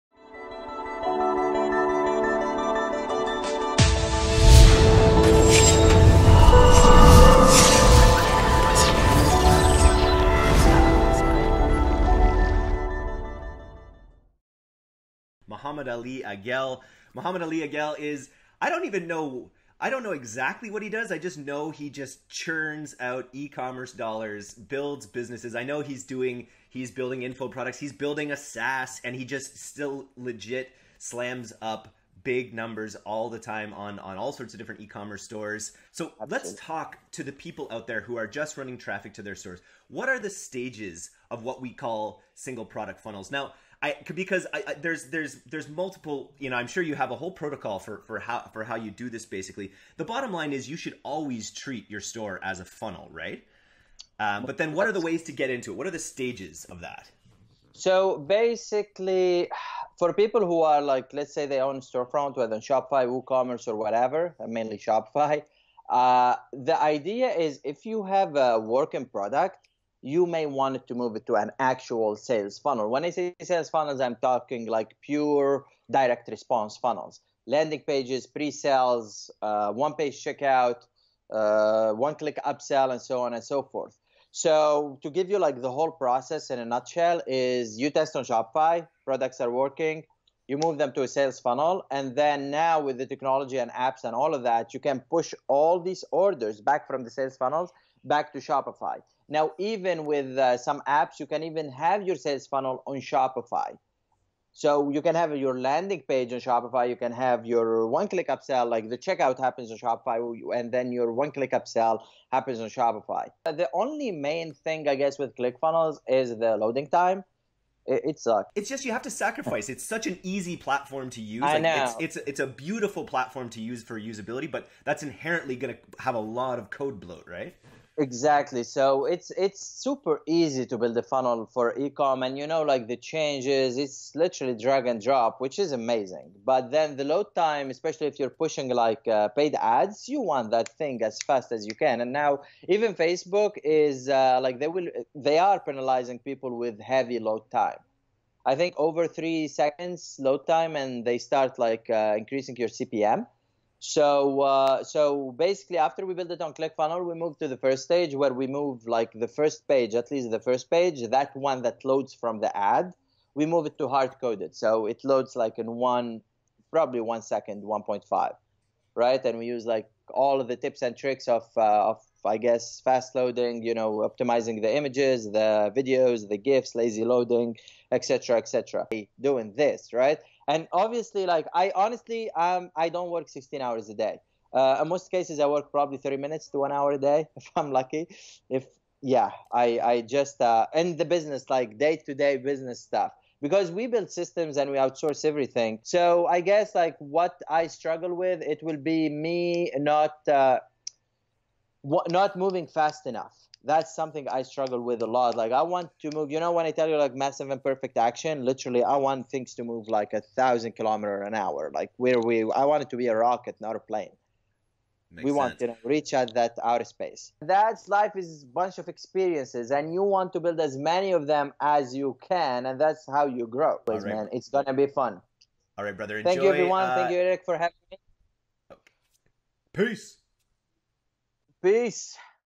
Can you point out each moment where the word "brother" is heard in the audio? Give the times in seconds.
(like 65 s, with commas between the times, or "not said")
225 s.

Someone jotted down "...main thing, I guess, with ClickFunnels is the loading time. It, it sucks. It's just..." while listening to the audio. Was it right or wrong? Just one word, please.
right.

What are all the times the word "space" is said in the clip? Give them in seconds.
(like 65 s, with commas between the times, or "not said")
216 s.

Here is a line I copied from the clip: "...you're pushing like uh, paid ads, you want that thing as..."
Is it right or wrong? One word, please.
right.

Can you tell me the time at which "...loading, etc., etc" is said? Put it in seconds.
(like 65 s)
177 s.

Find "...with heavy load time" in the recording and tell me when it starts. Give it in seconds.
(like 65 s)
146 s.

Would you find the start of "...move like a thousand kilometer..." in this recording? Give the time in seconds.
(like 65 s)
209 s.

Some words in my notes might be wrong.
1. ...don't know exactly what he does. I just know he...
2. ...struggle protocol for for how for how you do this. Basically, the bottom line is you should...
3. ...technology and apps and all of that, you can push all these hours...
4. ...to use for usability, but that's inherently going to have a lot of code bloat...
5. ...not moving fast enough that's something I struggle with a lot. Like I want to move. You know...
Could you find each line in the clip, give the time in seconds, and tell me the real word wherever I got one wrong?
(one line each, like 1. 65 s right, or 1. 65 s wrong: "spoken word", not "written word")
1. 19 s right
2. 47 s wrong: "whole", not "struggle"
3. 93 s wrong: "orders", not "hours"
4. 123 s right
5. 202 s right.